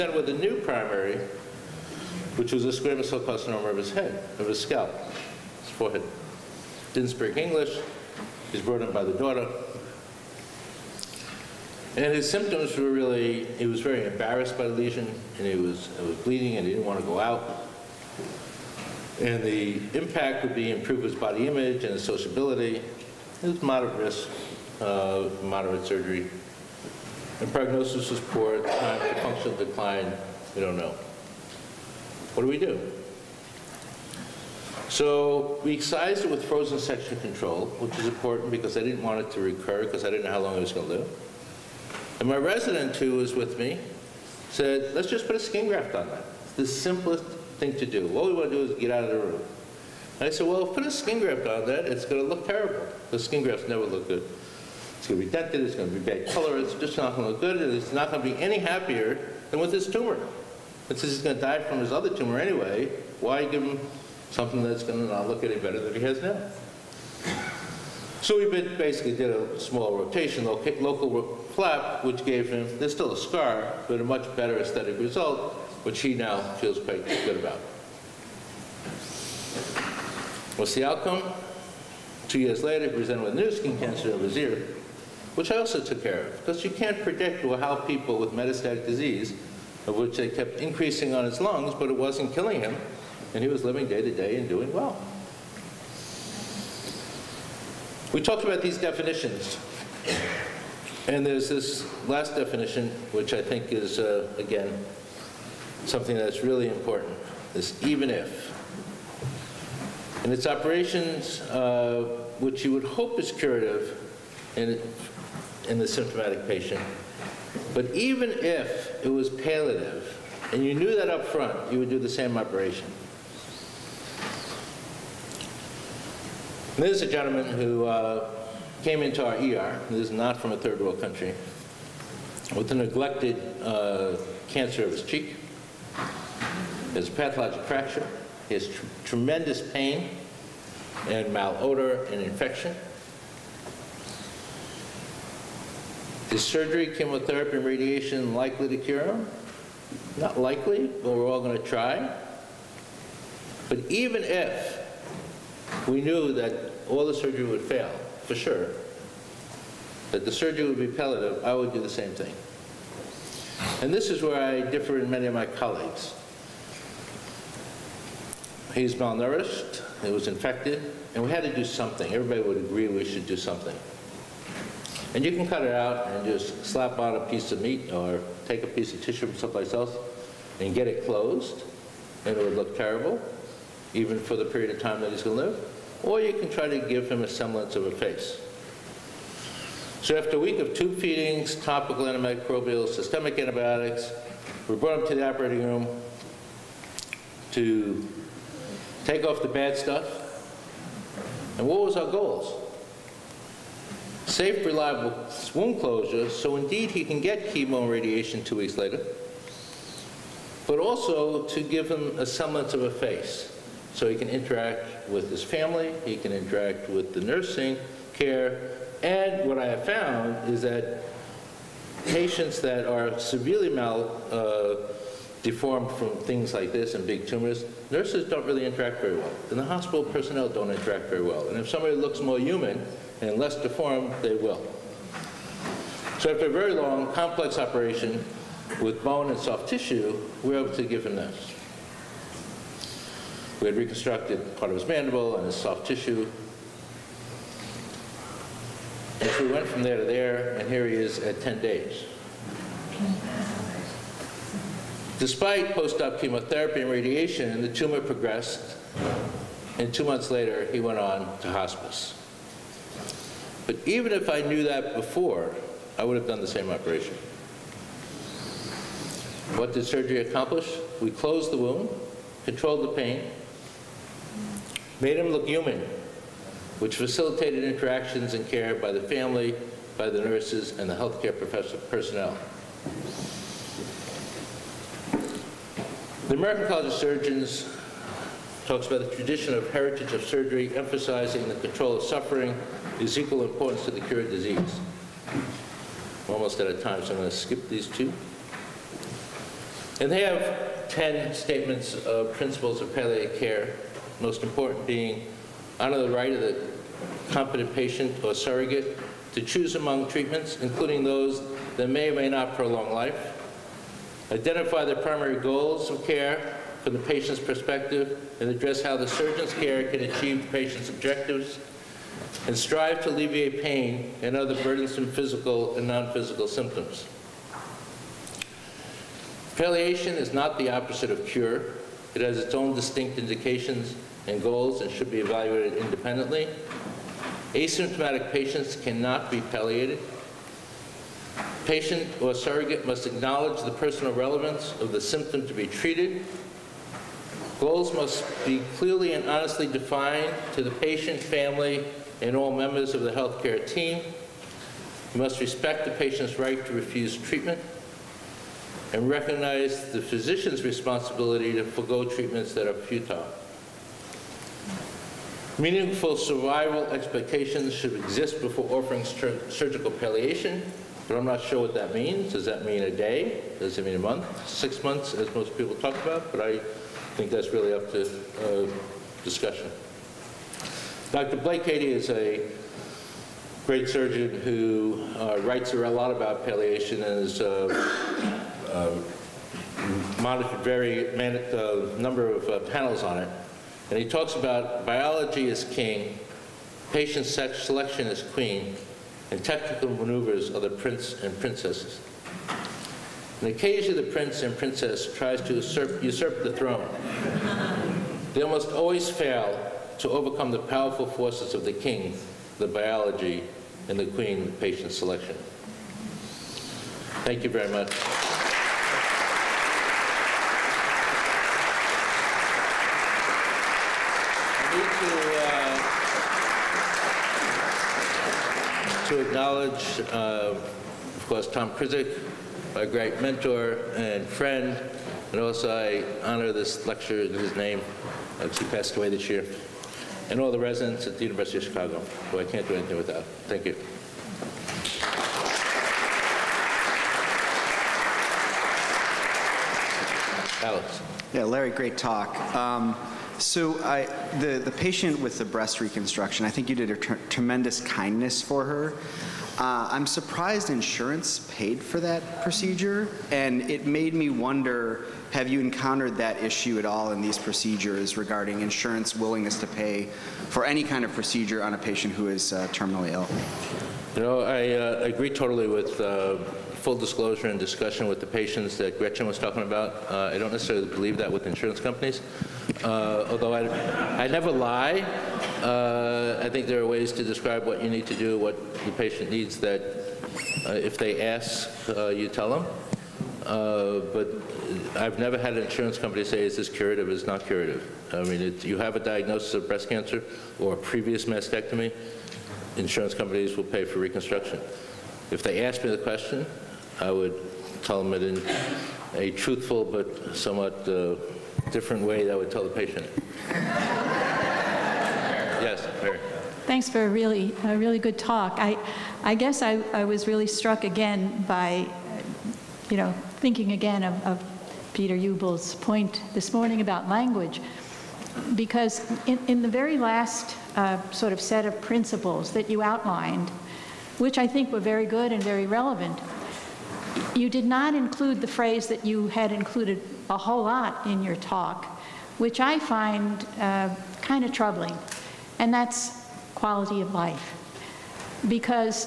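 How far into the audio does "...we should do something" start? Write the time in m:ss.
2:52.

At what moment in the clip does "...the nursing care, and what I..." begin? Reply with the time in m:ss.
3:37.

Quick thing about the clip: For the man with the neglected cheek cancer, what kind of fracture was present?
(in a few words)
pathologic fracture.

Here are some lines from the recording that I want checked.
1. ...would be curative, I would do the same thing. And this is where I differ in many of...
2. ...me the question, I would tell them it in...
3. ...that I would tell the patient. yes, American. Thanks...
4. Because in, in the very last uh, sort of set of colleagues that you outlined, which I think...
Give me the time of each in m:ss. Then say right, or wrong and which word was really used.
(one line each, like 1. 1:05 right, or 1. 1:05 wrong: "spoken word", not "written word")
1. 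2:40 wrong: "palliative", not "curative"
2. 8:25 right
3. 8:32 wrong: "Mary", not "American"
4. 8:48 wrong: "principles", not "colleagues".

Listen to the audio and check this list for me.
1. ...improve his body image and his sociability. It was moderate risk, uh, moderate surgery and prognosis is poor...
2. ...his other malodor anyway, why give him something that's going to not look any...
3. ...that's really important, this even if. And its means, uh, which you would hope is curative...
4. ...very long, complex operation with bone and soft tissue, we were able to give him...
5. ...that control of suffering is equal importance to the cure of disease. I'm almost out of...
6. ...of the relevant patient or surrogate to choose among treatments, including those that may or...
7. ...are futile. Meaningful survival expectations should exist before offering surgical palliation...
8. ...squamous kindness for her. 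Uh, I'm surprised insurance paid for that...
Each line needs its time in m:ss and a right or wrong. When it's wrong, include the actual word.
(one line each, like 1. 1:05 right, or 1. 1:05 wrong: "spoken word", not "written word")
1. 0:20 right
2. 1:01 wrong: "tumor", not "malodor"
3. 1:46 wrong: "operations", not "means"
4. 3:56 right
5. 4:51 right
6. 5:06 wrong: "competent", not "relevant"
7. 6:02 right
8. 7:36 wrong: "tremendous", not "squamous".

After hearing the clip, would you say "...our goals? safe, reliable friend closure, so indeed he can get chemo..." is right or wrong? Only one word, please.
wrong.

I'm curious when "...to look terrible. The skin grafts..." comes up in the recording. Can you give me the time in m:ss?
0:52.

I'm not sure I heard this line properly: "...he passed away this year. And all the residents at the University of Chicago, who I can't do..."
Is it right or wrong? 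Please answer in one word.
right.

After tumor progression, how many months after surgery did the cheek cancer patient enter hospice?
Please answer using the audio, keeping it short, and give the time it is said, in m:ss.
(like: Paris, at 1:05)
2, at 4:19.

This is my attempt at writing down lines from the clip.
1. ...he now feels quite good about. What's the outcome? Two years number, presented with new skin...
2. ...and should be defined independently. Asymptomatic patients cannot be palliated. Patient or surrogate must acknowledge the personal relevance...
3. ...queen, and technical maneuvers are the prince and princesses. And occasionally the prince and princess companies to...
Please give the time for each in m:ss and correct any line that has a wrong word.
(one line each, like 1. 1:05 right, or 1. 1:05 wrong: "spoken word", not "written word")
1. 1:15 wrong: "later", not "number"
2. 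5:34 wrong: "evaluated", not "defined"
3. 6:38 wrong: "tries", not "companies".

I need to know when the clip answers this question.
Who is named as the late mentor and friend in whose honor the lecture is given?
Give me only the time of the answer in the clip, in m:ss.
7:11.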